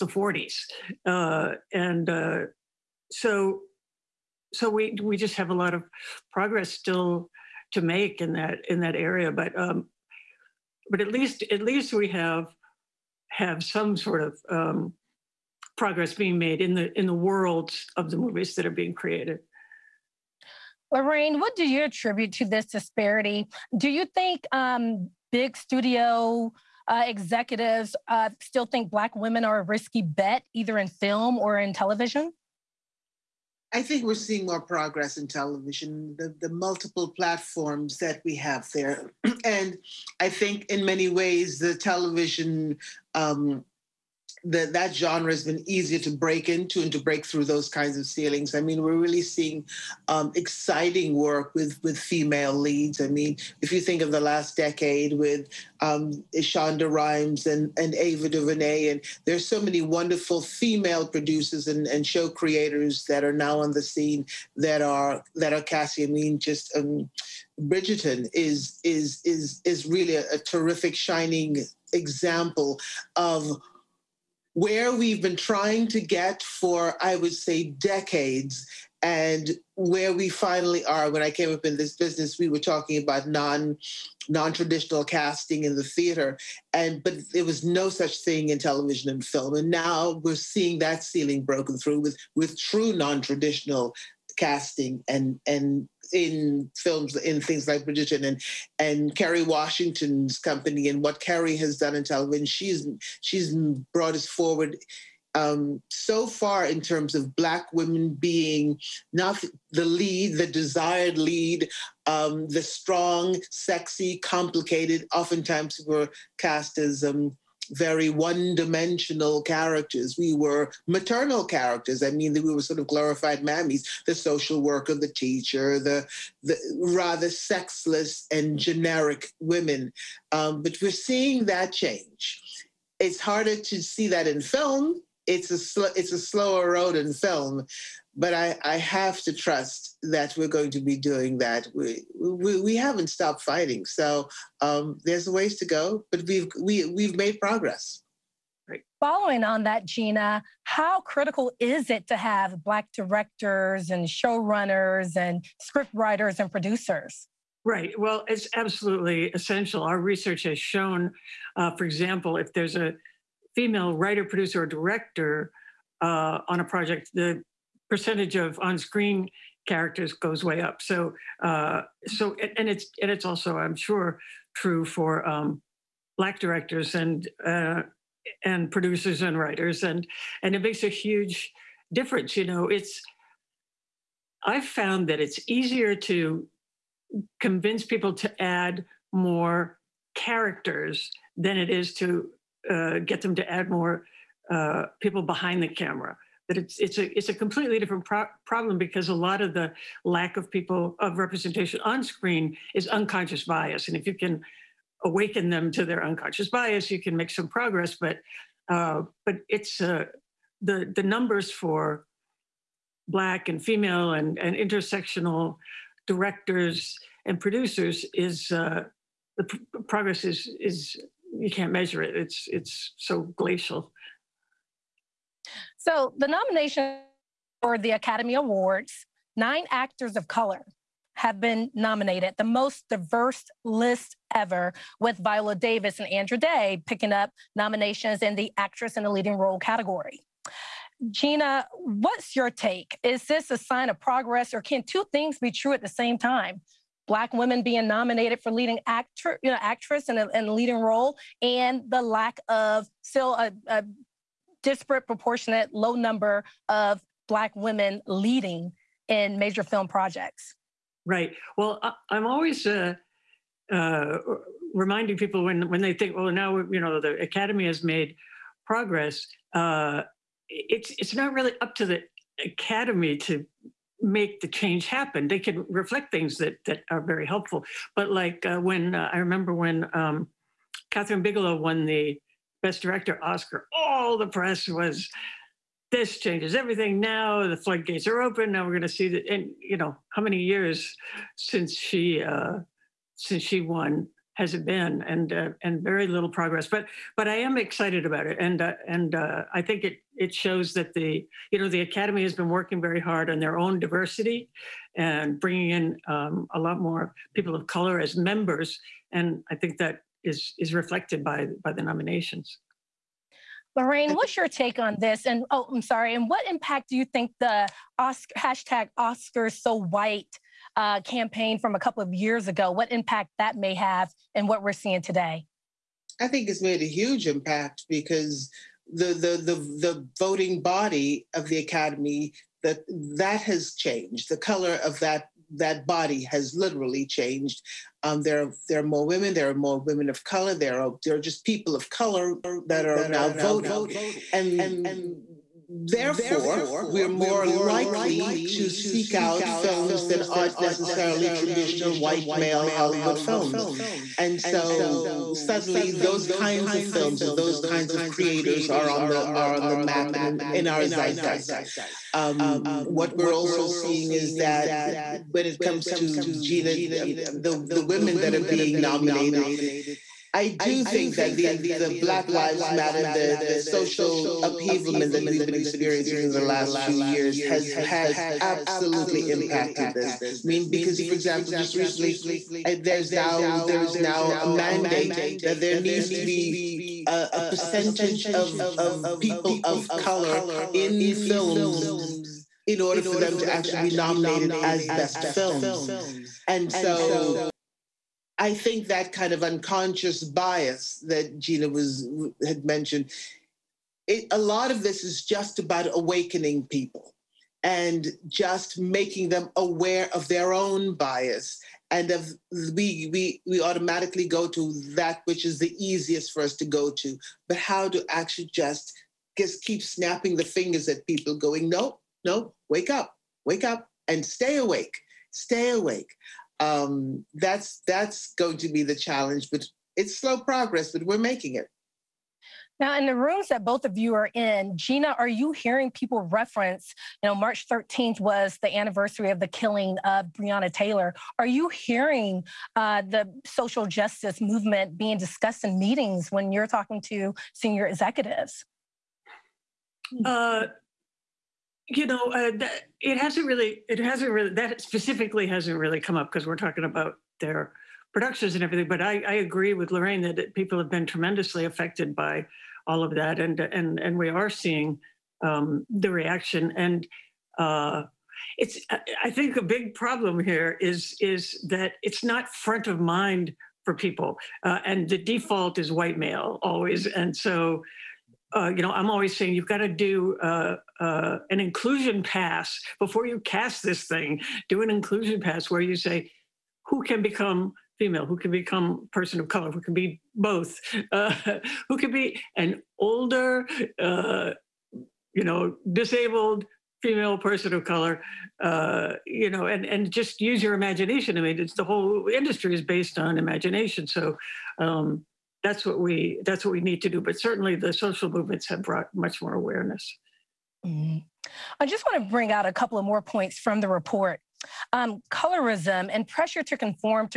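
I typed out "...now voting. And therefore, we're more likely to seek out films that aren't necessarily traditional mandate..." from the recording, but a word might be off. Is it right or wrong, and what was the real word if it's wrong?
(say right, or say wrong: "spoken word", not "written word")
wrong: "white", not "mandate".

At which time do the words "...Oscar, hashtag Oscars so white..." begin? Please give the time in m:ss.
5:17.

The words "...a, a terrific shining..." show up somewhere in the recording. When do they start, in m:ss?
1:10.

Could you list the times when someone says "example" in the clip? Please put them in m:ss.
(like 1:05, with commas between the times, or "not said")
1:11, 2:41, 6:21.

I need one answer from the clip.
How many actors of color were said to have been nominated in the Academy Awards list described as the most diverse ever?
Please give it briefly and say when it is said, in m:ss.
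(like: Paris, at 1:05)
9, at 3:49.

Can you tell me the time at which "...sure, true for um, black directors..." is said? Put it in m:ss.
2:53.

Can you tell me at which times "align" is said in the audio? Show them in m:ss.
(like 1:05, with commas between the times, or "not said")
not said.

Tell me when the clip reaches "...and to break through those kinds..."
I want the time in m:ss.
0:46.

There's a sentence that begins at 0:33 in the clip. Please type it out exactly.
I think we're seeing more progress in television, the, the multiple platforms that we have there.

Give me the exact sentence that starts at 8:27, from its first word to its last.
But certainly, the social movements have brought much more awareness.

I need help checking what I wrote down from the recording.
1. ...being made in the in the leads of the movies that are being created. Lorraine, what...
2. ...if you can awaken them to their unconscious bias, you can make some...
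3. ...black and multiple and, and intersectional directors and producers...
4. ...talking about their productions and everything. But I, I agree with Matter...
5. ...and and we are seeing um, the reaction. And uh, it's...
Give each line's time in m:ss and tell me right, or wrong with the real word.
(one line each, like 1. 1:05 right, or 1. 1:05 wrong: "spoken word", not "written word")
1. 0:16 wrong: "worlds", not "leads"
2. 3:23 right
3. 3:33 wrong: "female", not "multiple"
4. 7:36 wrong: "Lorraine", not "Matter"
5. 7:43 right.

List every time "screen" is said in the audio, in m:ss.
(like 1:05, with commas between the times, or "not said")
2:48, 3:22.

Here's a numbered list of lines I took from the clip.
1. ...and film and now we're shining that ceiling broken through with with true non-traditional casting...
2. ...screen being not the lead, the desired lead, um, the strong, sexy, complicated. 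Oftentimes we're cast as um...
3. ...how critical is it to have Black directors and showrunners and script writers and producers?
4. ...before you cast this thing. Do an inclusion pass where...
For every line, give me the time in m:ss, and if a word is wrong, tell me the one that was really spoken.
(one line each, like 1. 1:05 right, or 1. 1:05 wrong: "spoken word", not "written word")
1. 1:29 wrong: "seeing", not "shining"
2. 1:47 wrong: "women", not "screen"
3. 2:30 right
4. 8:02 right.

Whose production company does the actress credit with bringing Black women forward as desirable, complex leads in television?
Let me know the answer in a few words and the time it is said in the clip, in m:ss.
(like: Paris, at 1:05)
Kerry Washington, at 1:39.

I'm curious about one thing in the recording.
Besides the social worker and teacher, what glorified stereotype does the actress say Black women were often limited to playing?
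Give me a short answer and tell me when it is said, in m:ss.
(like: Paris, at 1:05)
mammies, at 2:02.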